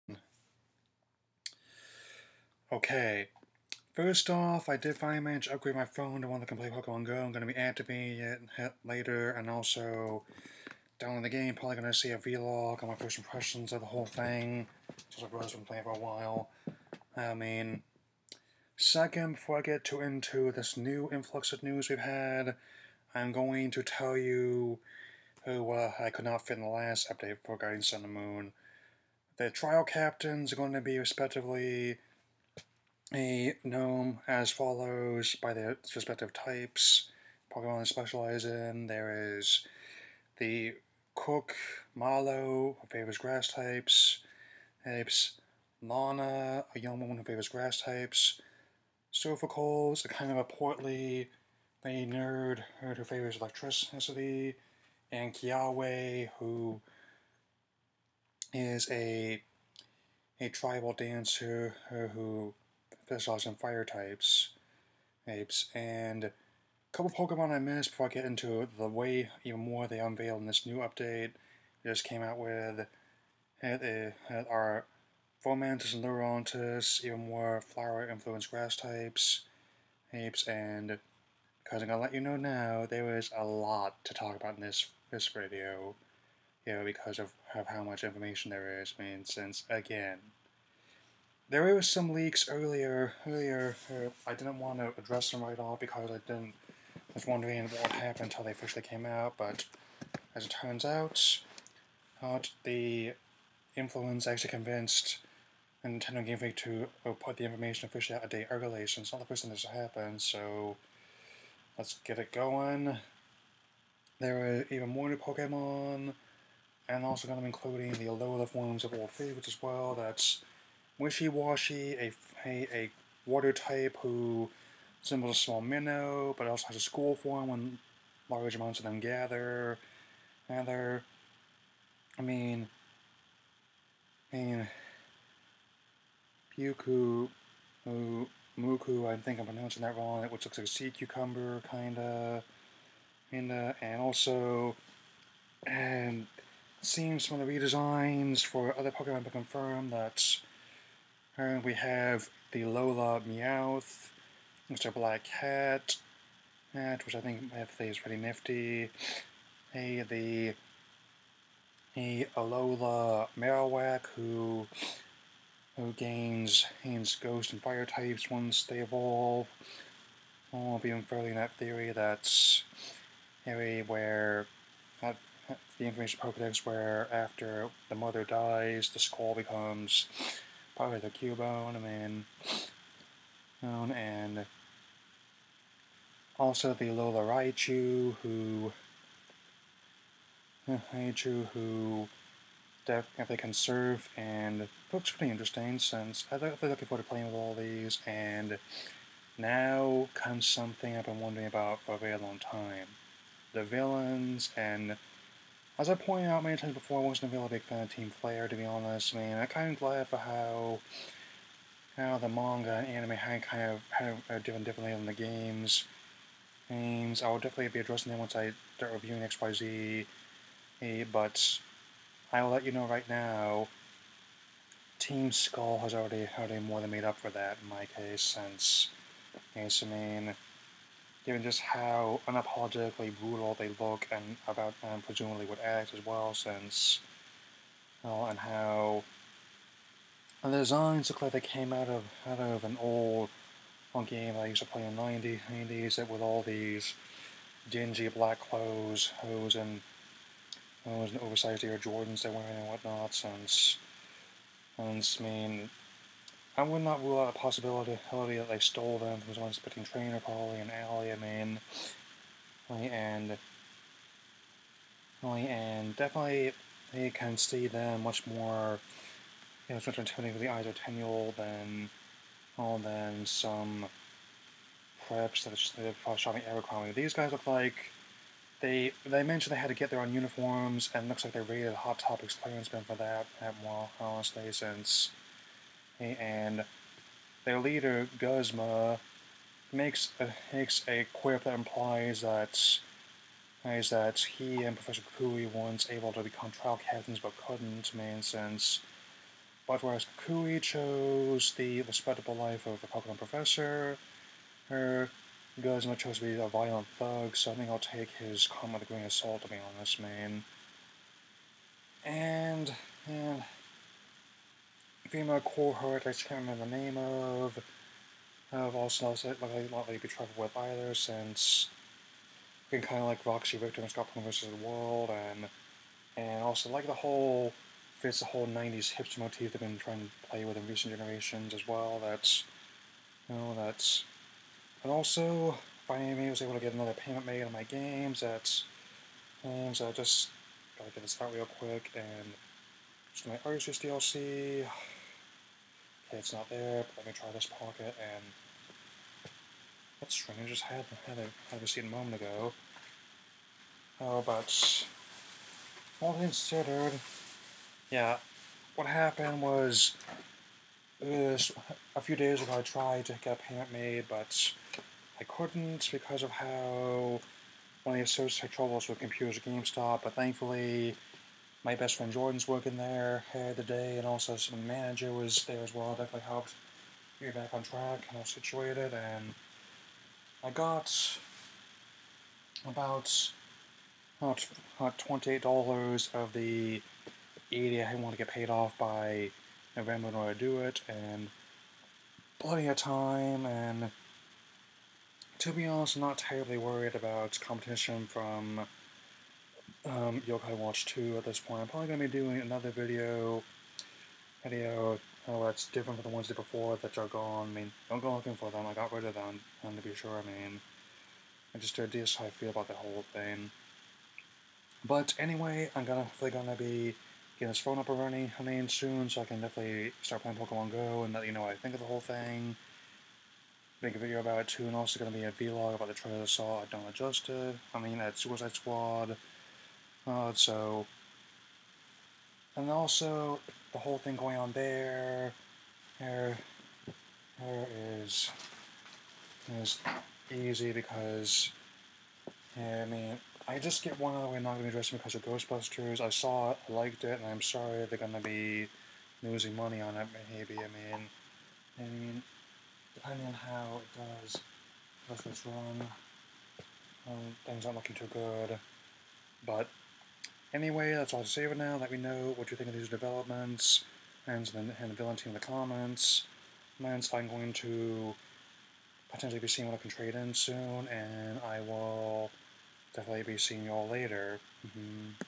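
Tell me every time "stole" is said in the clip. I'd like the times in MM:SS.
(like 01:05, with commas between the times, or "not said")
04:18.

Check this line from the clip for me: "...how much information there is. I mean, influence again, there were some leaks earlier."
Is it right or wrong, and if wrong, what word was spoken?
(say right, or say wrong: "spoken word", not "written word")
wrong: "since", not "influence".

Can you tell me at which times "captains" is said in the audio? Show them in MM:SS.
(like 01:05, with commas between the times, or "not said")
00:29, 04:56.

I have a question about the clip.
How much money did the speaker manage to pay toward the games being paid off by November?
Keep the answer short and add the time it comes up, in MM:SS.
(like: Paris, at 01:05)
$28, at 06:24.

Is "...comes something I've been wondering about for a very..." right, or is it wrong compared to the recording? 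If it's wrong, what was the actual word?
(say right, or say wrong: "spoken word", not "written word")
right.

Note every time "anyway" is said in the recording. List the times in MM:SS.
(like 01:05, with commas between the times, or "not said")
06:55, 07:40.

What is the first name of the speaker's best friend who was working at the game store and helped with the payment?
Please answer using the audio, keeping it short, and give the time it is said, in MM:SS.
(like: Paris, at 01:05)
Jordan, at 06:12.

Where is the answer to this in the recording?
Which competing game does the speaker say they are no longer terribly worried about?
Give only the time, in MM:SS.
06:40.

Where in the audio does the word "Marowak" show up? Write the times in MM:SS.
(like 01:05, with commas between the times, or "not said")
02:43.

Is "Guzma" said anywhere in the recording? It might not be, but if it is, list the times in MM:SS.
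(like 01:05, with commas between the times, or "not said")
04:48, 05:05.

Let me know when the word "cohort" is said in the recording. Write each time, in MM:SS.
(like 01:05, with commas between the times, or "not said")
05:15.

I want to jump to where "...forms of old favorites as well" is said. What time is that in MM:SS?
01:58.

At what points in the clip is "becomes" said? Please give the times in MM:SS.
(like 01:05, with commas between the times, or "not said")
02:59, 04:56.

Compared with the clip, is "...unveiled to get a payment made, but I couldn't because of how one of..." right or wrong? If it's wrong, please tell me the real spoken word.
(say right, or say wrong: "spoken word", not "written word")
wrong: "tried", not "unveiled".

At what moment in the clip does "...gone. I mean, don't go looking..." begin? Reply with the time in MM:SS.
06:47.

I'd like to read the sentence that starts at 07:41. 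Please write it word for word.
Let me know what you think of these developments and then and the villain team in the comments.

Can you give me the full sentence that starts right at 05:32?
That's you know that's and also finally I was able to get another payment made on my games.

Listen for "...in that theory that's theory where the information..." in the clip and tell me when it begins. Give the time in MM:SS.
02:51.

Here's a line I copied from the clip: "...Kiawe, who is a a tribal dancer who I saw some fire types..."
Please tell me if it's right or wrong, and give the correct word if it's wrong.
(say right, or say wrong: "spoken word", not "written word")
right.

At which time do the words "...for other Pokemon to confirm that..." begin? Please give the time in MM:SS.
02:28.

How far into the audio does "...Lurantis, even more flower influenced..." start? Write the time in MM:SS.
01:16.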